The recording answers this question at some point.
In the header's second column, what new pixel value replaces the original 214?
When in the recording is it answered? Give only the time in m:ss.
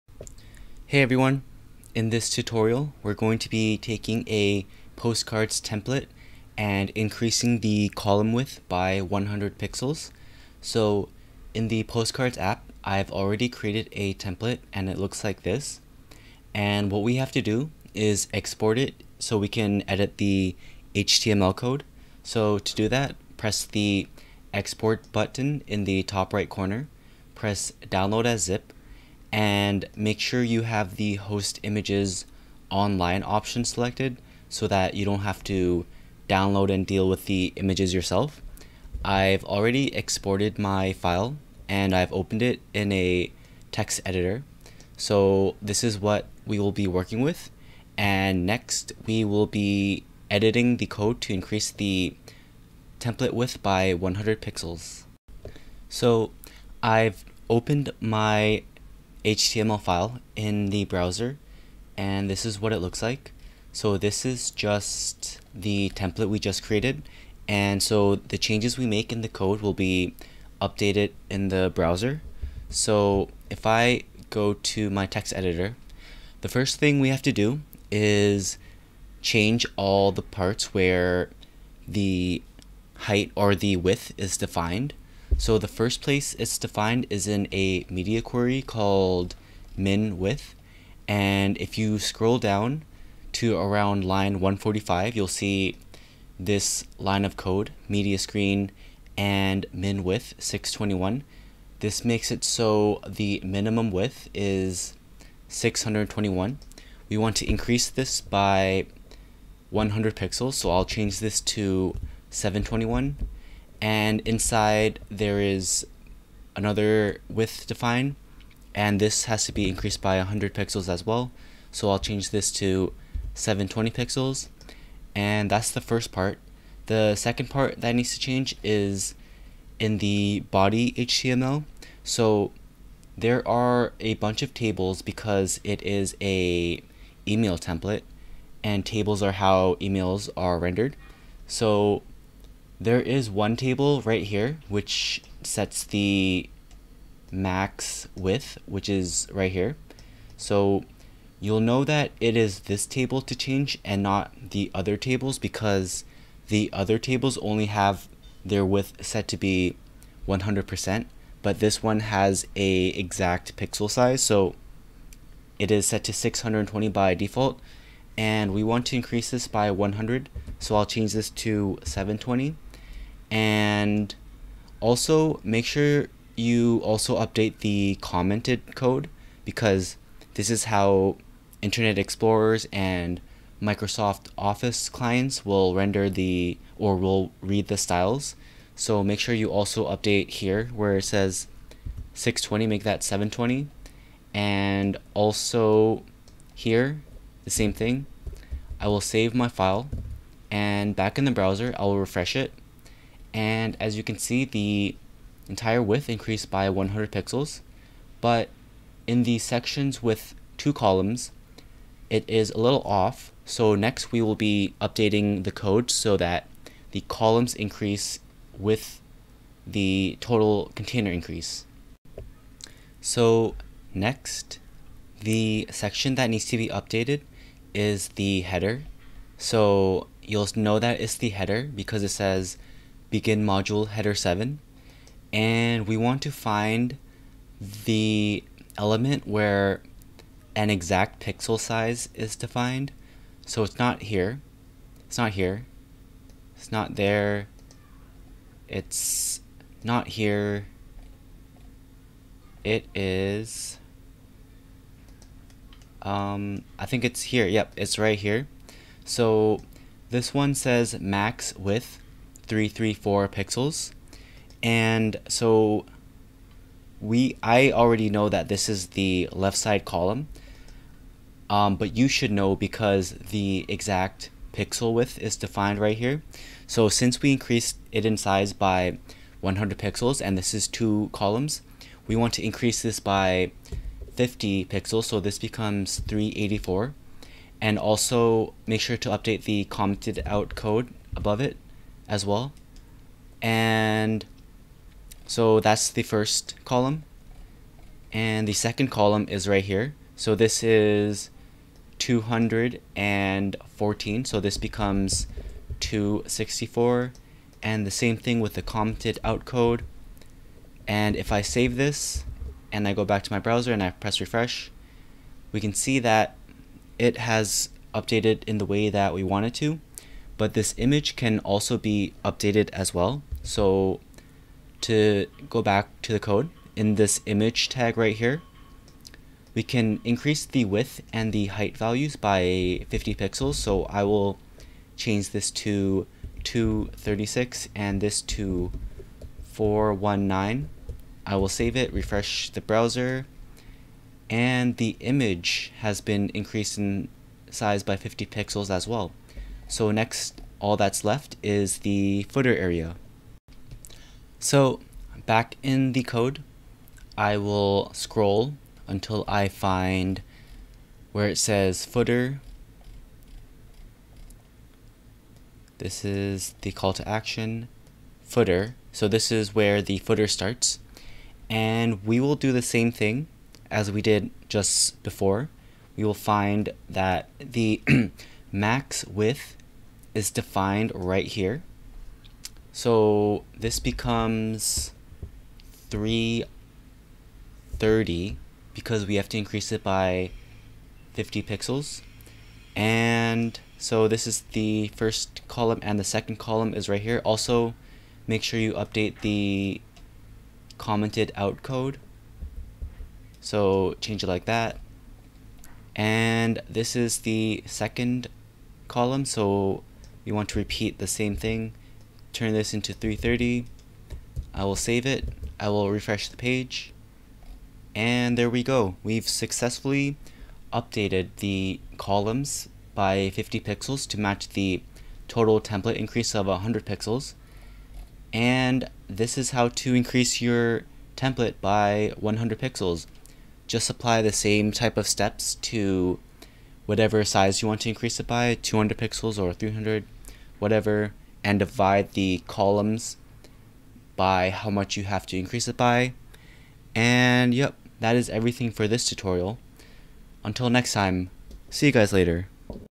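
5:05.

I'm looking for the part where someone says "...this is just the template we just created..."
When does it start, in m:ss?
1:03.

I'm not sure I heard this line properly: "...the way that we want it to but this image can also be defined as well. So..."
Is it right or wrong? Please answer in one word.
wrong.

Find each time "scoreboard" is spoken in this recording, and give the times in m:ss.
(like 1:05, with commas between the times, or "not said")
not said.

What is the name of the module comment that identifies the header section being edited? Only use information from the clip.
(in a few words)
begin module header 7.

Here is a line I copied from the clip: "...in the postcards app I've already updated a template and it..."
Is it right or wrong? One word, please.
wrong.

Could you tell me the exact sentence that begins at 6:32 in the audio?
And so this is the first column and the second column is right here.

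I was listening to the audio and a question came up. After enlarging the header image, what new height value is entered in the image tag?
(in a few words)
419.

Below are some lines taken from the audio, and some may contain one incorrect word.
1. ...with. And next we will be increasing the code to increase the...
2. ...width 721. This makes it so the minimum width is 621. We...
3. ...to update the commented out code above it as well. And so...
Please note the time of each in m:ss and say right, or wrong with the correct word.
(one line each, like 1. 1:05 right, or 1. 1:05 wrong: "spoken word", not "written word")
1. 0:47 wrong: "editing", not "increasing"
2. 1:40 wrong: "621", not "721"
3. 4:48 right.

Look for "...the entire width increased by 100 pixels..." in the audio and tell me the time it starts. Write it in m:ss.
3:24.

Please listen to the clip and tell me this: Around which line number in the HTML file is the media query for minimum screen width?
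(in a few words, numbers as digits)
145.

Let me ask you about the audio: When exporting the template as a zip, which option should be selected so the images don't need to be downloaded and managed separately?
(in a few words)
host images online.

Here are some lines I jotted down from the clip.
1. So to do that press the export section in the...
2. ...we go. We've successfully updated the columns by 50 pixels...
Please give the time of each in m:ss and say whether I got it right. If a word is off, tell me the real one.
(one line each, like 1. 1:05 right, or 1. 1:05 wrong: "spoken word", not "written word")
1. 0:22 wrong: "button", not "section"
2. 6:58 right.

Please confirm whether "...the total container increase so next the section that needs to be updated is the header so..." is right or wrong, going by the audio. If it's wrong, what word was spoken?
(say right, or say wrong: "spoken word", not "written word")
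right.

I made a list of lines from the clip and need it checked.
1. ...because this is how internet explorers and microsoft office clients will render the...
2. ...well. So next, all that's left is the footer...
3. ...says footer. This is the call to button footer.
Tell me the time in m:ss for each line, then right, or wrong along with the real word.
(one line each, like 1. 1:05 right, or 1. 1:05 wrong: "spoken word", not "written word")
1. 2:59 right
2. 5:48 right
3. 6:01 wrong: "action", not "button".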